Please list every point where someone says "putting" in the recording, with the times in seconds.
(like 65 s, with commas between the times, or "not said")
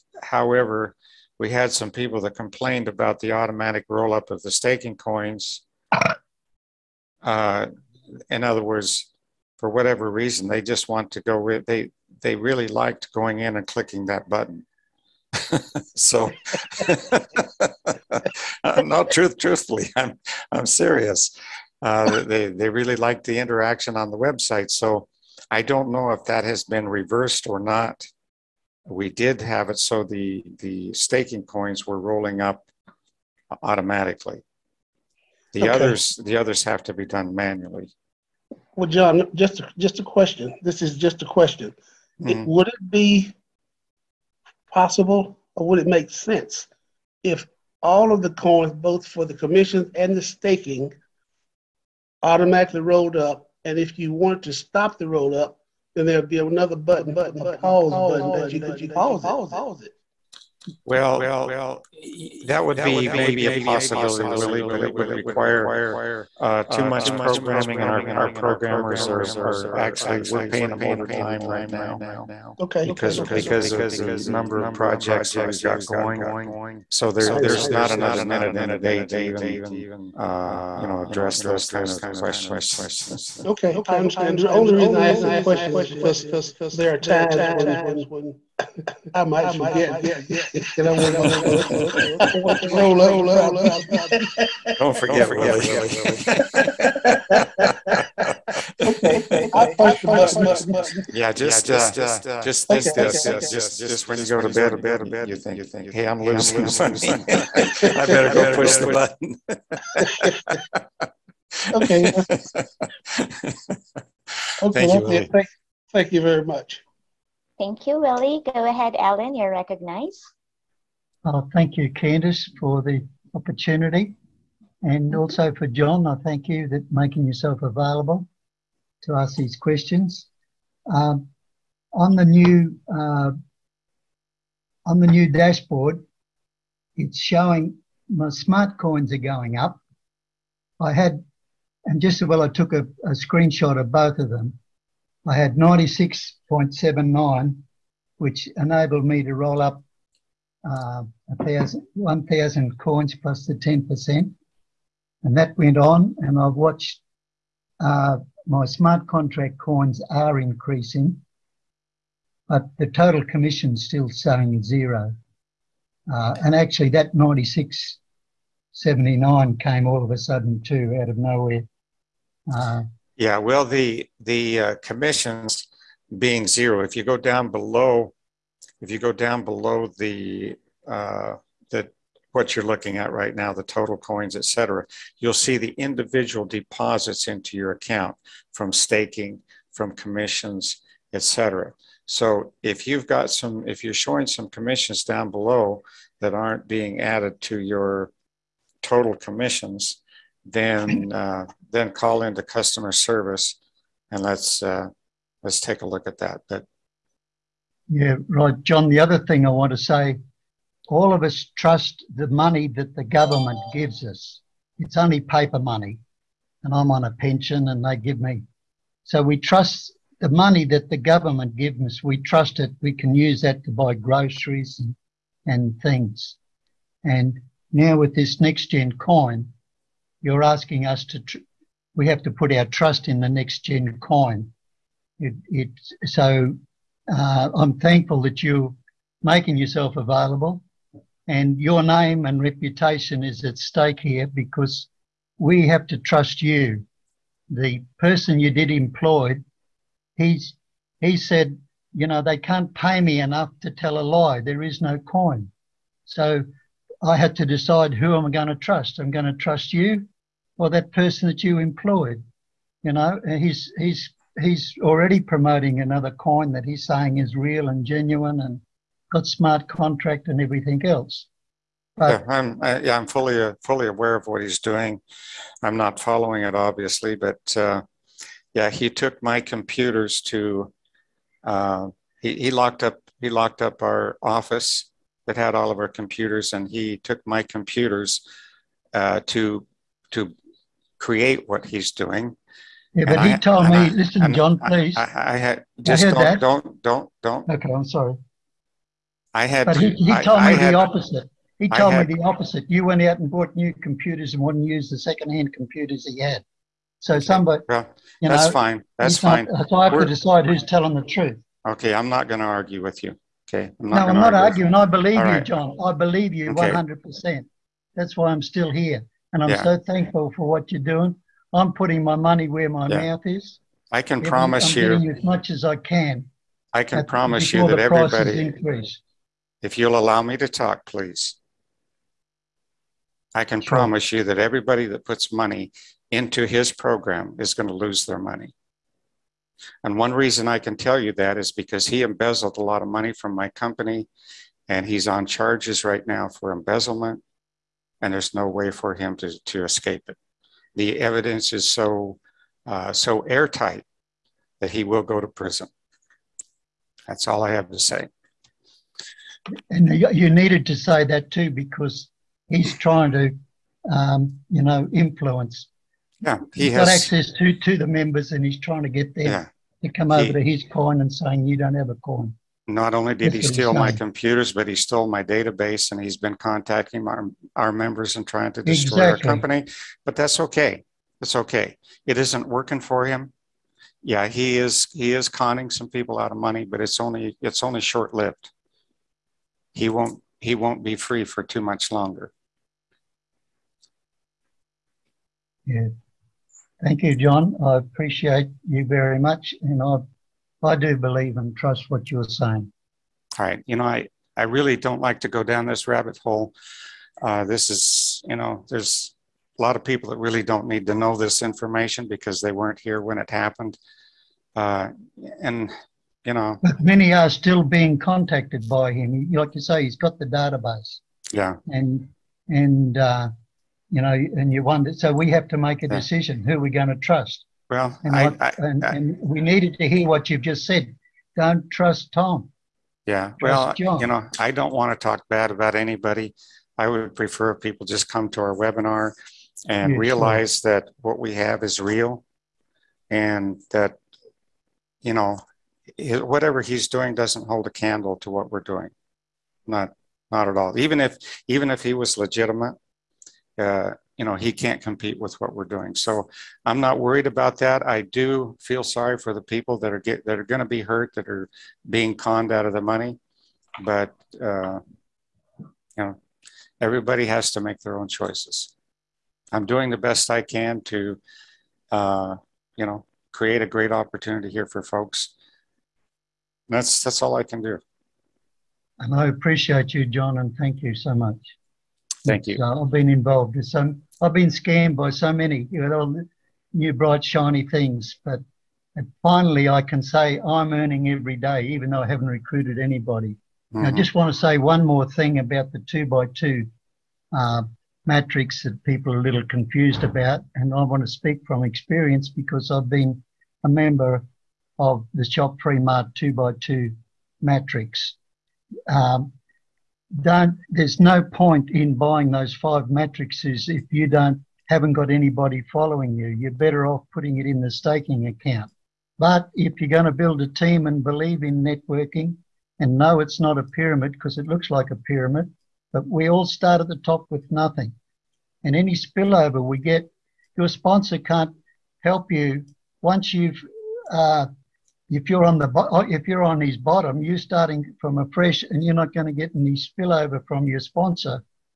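321 s, 517 s.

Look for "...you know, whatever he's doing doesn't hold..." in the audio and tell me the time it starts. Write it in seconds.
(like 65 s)
445 s.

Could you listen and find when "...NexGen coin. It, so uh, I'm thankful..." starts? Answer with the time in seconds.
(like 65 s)
233 s.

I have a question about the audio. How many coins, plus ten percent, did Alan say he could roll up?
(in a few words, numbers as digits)
1,000.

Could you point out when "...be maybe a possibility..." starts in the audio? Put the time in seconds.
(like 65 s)
62 s.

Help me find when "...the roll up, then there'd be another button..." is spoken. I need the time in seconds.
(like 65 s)
54 s.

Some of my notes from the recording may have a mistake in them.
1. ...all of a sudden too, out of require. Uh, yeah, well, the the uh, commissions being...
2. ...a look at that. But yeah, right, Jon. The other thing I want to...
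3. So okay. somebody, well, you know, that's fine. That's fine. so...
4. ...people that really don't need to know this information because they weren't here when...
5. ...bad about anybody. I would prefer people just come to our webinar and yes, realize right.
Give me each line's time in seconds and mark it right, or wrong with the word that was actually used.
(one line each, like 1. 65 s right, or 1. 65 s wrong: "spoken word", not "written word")
1. 169 s wrong: "nowhere", not "require"
2. 205 s right
3. 307 s right
4. 409 s right
5. 435 s right.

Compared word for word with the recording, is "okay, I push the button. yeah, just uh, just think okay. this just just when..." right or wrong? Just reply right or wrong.
right.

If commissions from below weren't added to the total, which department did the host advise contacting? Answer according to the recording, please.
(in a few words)
customer service.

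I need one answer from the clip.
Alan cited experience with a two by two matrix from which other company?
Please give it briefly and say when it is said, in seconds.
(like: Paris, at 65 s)
ShopFreeMart, at 505 s.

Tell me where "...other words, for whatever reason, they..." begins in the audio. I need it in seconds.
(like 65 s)
8 s.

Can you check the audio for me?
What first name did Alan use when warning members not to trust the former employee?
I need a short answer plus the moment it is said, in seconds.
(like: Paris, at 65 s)
Tom, at 432 s.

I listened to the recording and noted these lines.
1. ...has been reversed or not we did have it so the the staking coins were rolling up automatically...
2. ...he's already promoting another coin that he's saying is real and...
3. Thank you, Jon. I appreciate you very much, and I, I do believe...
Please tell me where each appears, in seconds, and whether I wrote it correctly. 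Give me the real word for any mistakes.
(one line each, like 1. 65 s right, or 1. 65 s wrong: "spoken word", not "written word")
1. 26 s right
2. 264 s right
3. 396 s right.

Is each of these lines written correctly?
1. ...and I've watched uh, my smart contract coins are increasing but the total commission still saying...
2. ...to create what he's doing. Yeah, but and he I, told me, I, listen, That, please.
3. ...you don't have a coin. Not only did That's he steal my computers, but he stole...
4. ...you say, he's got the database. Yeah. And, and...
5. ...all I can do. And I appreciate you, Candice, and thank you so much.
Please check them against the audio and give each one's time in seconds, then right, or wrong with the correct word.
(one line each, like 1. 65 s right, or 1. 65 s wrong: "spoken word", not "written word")
1. 156 s right
2. 290 s wrong: "Jon", not "That"
3. 371 s right
4. 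419 s right
5. 477 s wrong: "Jon", not "Candice".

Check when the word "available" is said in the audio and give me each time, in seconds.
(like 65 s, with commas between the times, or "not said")
127 s, 239 s.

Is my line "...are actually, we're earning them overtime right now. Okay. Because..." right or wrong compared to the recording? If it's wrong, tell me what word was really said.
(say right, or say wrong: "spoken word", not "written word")
wrong: "paying", not "earning".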